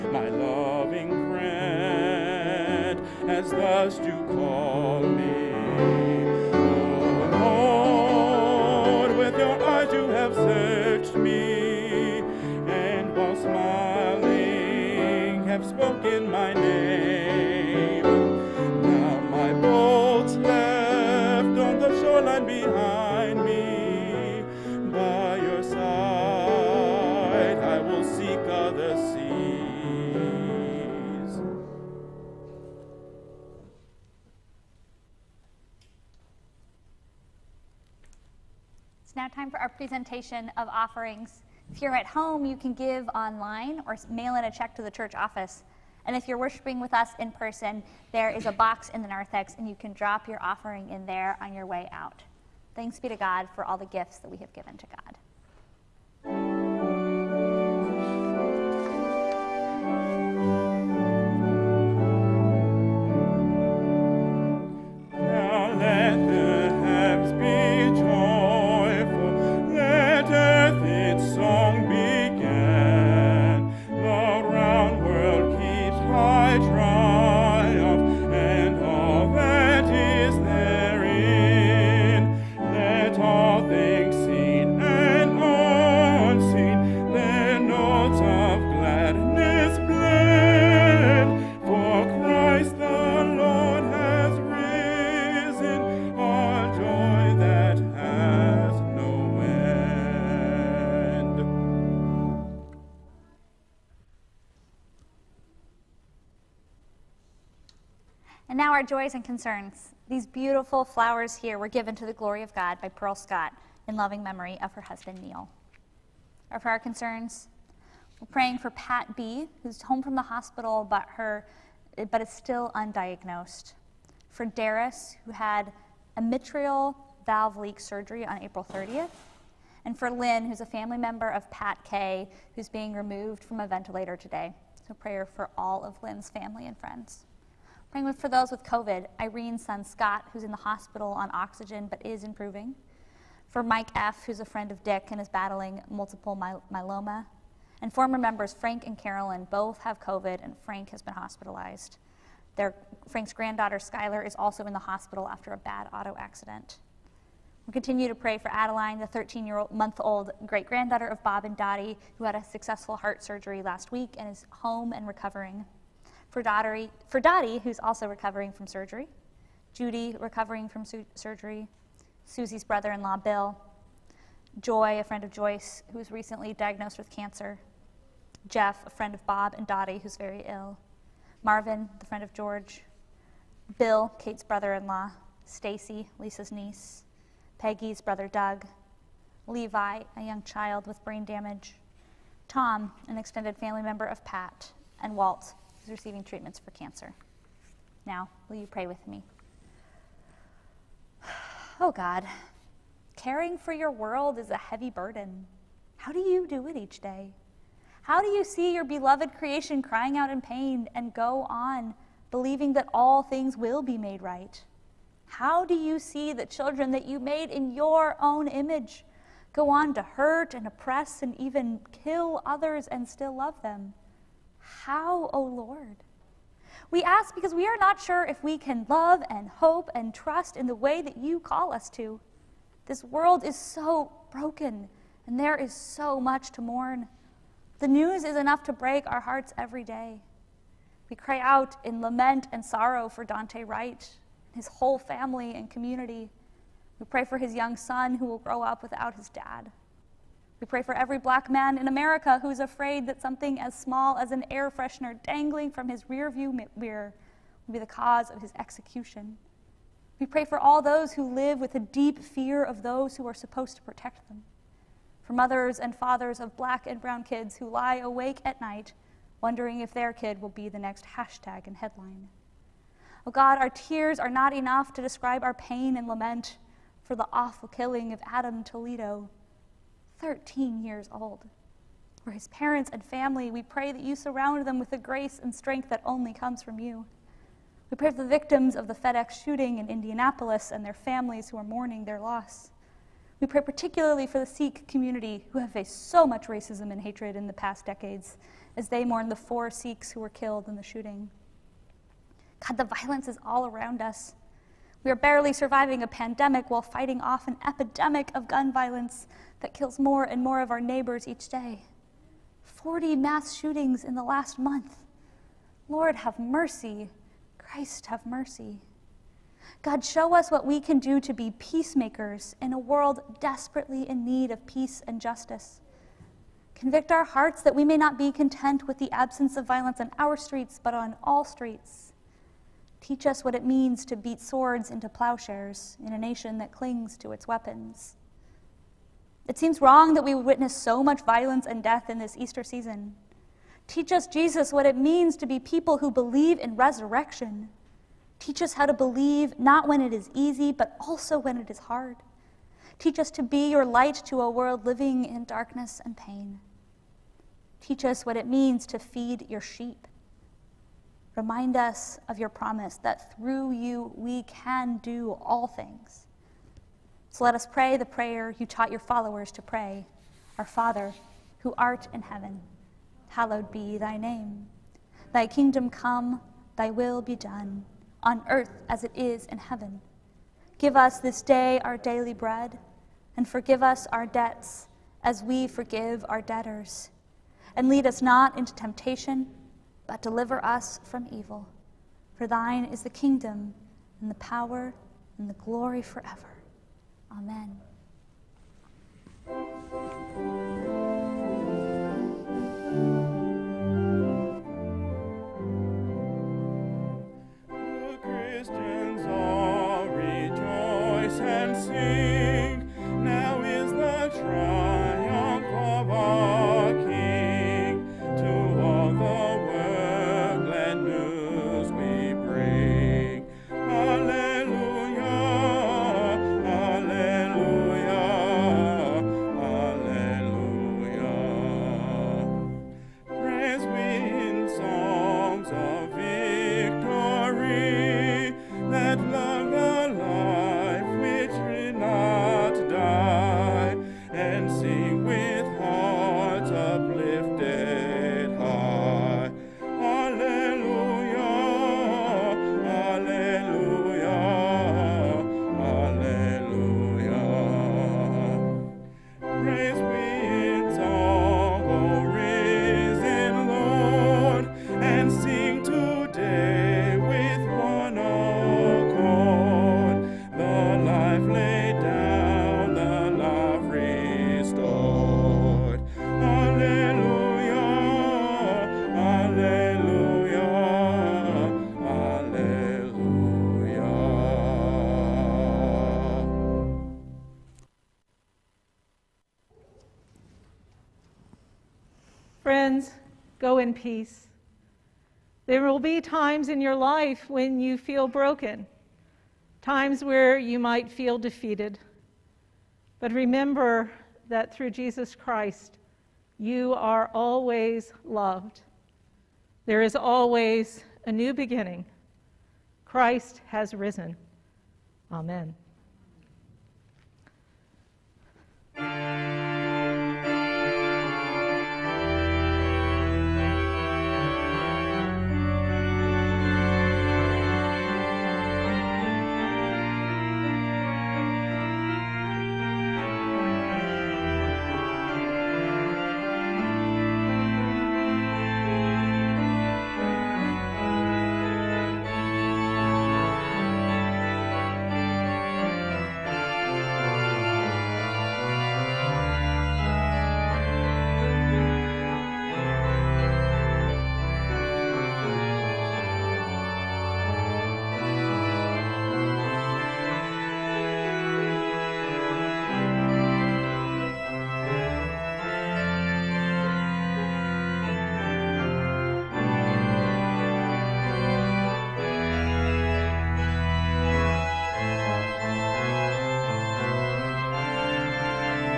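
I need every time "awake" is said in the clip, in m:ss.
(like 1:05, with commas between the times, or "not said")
4:27.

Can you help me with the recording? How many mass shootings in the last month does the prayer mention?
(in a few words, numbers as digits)
40.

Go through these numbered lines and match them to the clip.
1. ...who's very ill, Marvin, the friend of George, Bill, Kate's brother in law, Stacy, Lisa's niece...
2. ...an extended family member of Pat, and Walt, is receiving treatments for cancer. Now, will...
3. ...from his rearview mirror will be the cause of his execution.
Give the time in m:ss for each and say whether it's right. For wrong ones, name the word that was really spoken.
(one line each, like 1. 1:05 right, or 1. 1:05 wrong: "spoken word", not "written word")
1. 3:00 right
2. 3:13 right
3. 4:15 right.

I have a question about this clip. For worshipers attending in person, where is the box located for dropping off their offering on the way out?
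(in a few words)
The narthex.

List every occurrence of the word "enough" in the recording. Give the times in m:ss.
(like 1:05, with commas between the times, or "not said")
3:58, 4:34.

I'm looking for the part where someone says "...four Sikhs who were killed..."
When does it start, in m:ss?
4:59.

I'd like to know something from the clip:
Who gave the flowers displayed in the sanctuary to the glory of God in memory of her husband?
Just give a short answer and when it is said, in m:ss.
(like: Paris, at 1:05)
Pearl Scott, at 1:52.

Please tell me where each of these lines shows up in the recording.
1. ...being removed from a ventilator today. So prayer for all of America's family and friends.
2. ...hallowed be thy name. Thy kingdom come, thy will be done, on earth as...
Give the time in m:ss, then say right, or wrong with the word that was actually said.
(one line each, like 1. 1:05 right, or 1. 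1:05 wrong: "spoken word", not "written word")
1. 2:12 wrong: "Lynn", not "America"
2. 6:13 right.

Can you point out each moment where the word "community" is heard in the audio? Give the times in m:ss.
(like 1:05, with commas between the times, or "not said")
4:05, 4:54.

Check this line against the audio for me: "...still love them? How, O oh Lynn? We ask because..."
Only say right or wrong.
wrong.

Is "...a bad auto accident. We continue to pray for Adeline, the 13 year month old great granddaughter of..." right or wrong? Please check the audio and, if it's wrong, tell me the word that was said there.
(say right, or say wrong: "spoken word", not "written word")
right.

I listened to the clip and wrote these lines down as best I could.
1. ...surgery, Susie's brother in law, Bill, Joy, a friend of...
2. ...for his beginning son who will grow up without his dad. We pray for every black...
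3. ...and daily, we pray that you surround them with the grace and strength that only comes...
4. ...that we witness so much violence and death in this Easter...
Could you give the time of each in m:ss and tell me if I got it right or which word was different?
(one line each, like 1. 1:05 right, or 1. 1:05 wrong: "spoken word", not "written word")
1. 2:51 right
2. 4:07 wrong: "young", not "beginning"
3. 4:42 wrong: "family", not "daily"
4. 5:40 right.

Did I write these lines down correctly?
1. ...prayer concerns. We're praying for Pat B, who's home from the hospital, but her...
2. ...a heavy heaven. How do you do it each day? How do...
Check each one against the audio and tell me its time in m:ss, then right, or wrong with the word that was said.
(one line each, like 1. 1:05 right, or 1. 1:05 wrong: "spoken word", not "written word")
1. 1:56 right
2. 3:24 wrong: "burden", not "heaven".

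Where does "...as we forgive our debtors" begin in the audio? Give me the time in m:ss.
6:25.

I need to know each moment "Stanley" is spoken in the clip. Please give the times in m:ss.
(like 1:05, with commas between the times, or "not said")
not said.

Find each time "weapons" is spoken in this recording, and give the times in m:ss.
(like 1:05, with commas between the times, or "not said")
5:37.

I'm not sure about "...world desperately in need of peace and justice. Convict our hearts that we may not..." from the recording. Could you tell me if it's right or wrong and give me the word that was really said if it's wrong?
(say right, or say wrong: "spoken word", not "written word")
right.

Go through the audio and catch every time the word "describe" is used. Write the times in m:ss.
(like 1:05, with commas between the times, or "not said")
4:35.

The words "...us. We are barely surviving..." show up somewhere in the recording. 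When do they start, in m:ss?
5:04.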